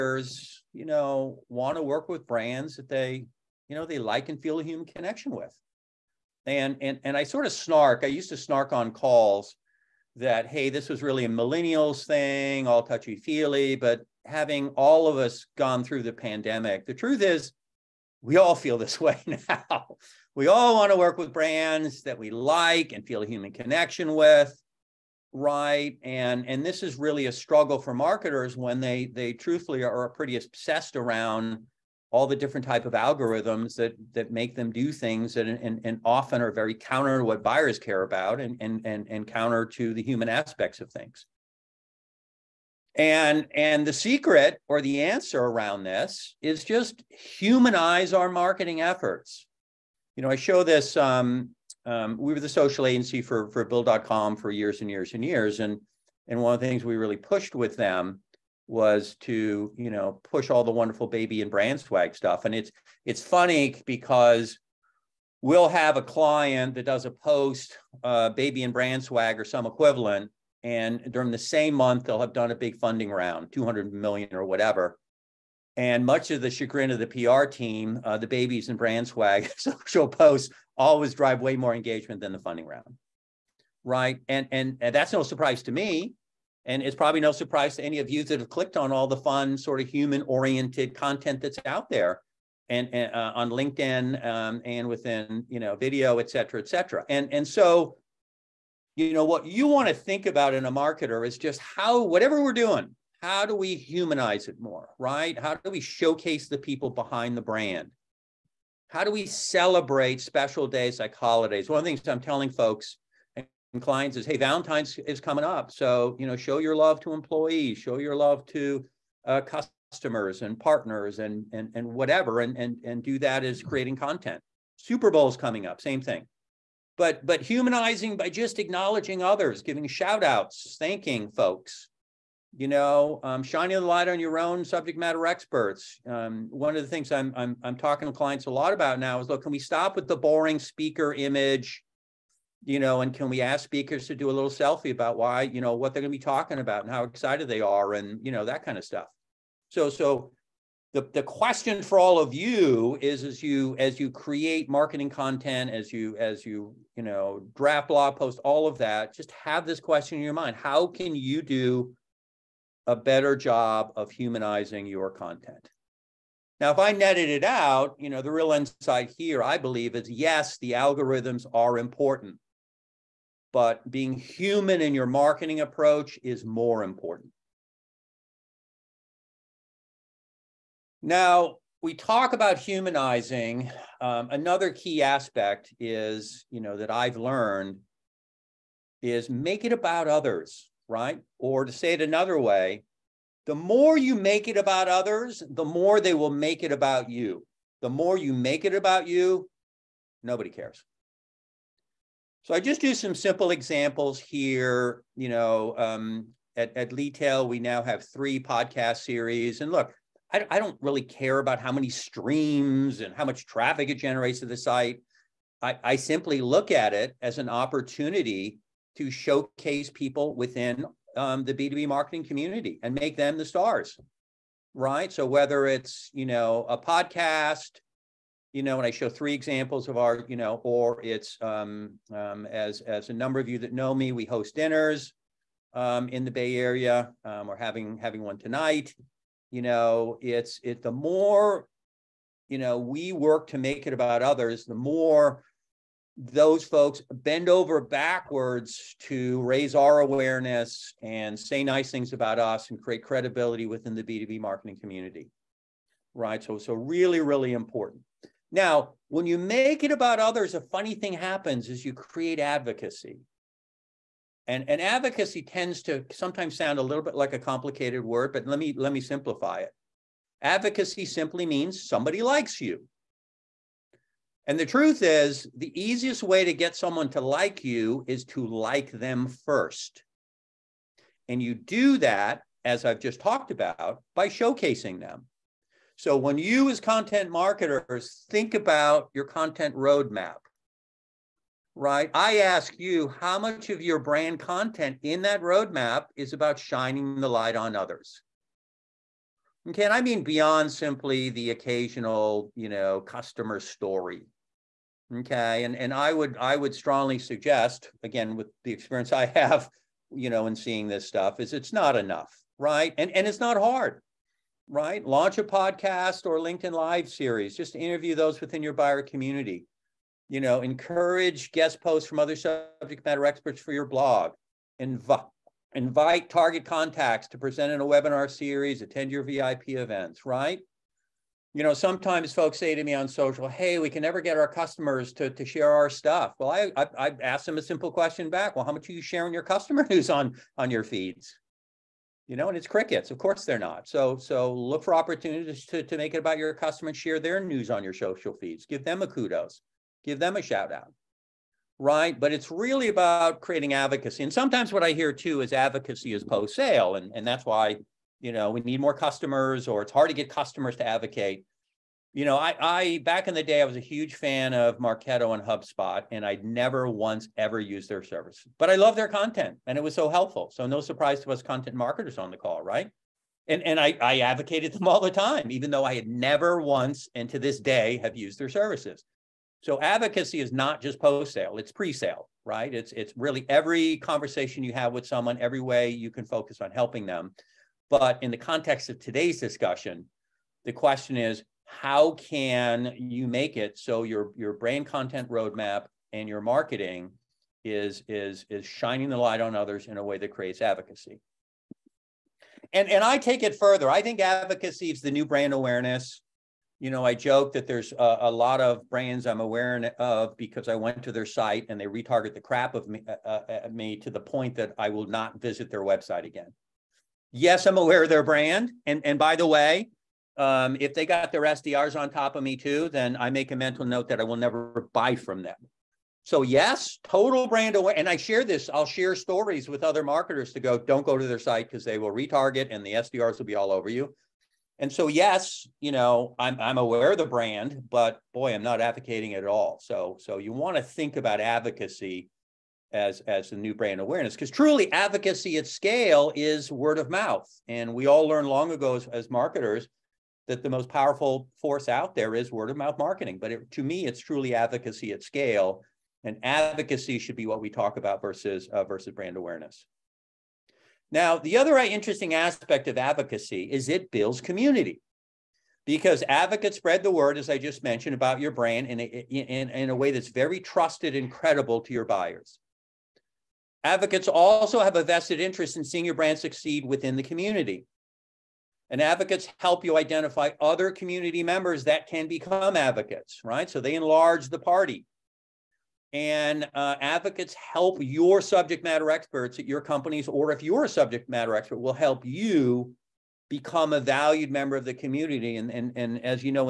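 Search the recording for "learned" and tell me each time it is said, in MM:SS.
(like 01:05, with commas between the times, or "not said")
03:07, 07:28.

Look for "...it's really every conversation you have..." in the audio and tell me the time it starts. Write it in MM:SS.
06:22.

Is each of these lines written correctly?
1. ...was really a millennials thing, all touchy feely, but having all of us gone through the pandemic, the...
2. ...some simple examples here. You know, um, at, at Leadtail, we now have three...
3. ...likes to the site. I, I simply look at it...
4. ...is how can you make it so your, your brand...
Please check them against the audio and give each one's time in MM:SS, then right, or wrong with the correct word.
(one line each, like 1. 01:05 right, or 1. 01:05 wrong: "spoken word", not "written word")
1. 00:10 right
2. 03:22 right
3. 03:33 wrong: "generates", not "likes"
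4. 06:31 right.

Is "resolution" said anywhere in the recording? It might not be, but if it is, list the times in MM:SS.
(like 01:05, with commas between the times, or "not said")
not said.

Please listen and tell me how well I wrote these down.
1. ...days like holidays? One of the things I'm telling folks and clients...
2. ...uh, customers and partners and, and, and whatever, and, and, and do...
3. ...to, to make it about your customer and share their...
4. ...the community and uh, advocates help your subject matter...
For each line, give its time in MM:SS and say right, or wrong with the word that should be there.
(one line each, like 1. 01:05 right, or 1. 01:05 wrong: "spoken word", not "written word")
1. 01:50 right
2. 01:59 right
3. 05:45 right
4. 08:04 wrong: "party", not "community".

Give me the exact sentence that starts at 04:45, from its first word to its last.
So when you, as content marketers, think about your content roadmap, right?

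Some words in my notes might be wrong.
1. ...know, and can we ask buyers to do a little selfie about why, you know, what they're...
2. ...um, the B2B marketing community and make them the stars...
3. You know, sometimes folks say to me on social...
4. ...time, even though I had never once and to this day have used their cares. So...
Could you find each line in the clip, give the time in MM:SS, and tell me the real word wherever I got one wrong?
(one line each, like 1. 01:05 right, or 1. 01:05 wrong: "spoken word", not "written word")
1. 02:22 wrong: "speakers", not "buyers"
2. 03:41 right
3. 05:31 right
4. 06:15 wrong: "services", not "cares".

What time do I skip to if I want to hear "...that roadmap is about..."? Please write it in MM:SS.
04:55.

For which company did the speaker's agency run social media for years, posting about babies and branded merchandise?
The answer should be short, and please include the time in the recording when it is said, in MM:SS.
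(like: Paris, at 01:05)
Bill.com, at 00:53.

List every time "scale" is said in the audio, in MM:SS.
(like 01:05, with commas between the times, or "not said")
07:25, 07:35.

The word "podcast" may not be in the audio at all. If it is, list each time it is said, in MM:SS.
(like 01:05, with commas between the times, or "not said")
03:28, 03:46, 05:15.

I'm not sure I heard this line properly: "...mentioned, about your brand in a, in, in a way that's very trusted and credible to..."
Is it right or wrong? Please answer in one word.
right.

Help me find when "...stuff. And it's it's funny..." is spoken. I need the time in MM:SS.
01:02.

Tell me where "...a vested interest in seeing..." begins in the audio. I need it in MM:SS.
07:54.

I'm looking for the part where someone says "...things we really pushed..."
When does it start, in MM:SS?
00:56.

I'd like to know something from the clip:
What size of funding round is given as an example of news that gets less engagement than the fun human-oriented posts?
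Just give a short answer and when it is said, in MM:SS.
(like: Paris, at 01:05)
200 million, at 01:13.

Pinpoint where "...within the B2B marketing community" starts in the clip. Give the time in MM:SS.
04:13.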